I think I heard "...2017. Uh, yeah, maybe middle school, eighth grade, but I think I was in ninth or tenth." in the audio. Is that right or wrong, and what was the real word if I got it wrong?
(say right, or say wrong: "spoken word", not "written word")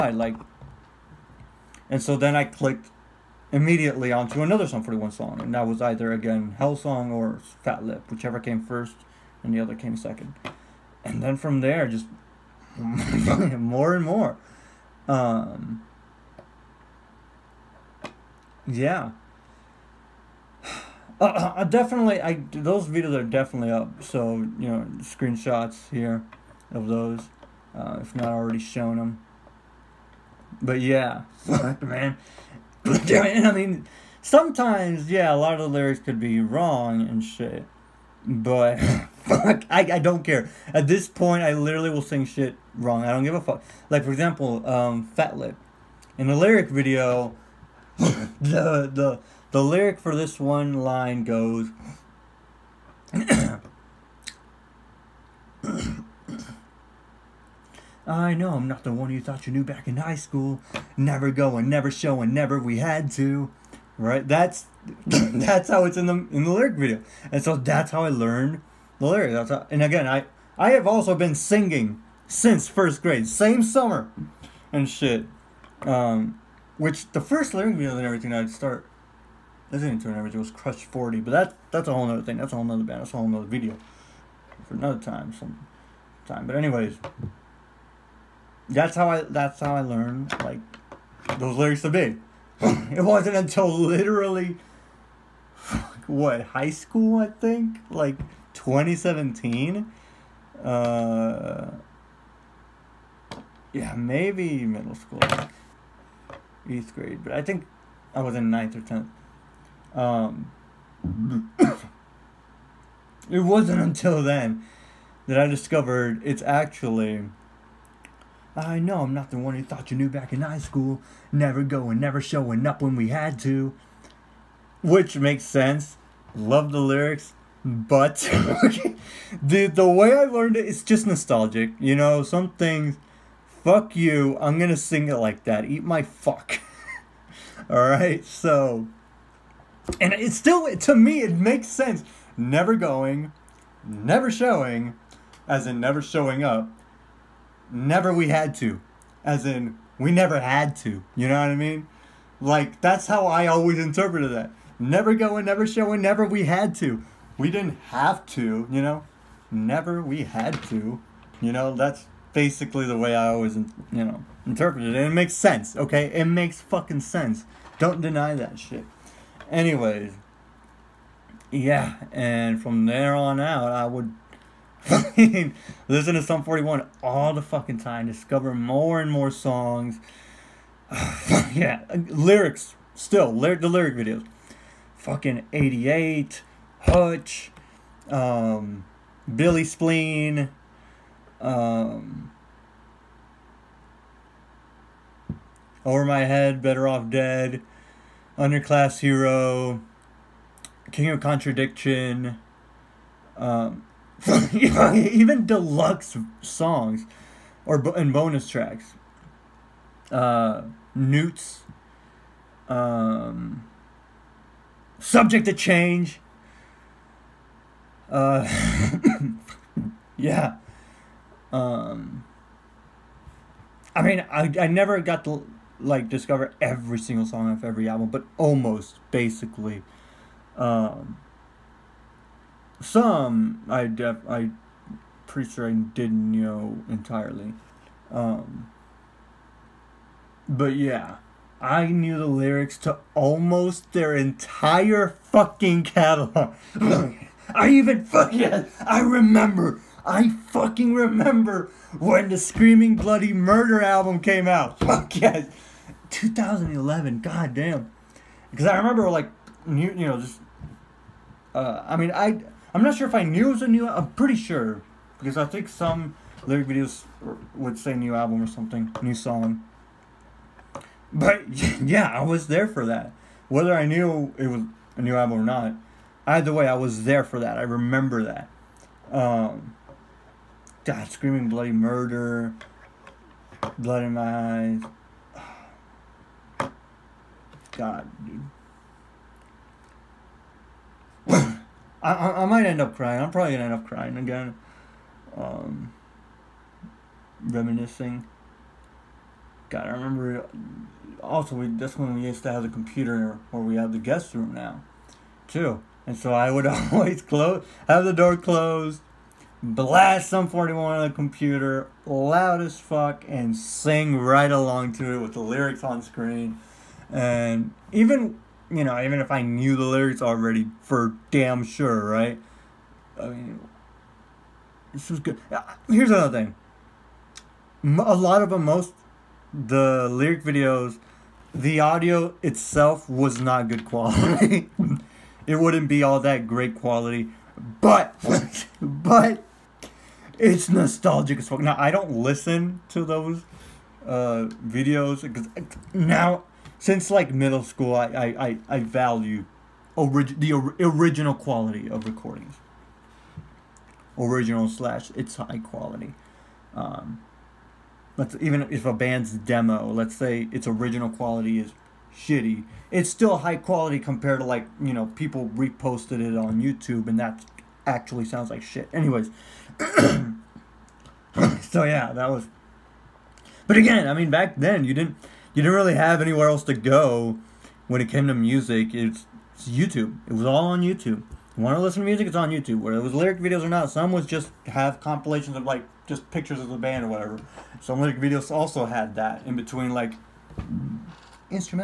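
right.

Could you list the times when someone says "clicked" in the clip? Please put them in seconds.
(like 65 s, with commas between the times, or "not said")
2 s.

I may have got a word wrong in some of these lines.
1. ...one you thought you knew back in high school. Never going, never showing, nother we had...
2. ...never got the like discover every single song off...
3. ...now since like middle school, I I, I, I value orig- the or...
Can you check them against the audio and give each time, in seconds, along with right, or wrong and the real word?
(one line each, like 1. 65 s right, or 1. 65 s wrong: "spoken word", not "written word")
1. 58 s wrong: "never", not "nother"
2. 224 s right
3. 345 s right.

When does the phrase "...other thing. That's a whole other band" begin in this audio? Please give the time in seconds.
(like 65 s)
82 s.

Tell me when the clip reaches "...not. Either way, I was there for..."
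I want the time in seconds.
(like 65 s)
275 s.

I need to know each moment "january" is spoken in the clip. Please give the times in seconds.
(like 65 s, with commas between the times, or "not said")
not said.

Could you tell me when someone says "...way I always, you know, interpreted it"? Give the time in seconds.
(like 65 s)
162 s.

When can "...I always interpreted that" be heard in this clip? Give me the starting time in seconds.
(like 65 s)
153 s.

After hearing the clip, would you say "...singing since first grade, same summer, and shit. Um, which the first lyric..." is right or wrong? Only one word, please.
right.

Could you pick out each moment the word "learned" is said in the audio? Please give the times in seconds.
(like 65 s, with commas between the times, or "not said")
68 s, 89 s, 130 s.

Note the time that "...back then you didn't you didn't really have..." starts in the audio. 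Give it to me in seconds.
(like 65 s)
374 s.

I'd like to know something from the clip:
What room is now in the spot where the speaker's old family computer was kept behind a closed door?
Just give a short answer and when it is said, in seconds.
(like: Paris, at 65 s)
Guest room, at 303 s.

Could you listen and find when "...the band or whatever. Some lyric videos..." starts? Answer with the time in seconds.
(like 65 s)
386 s.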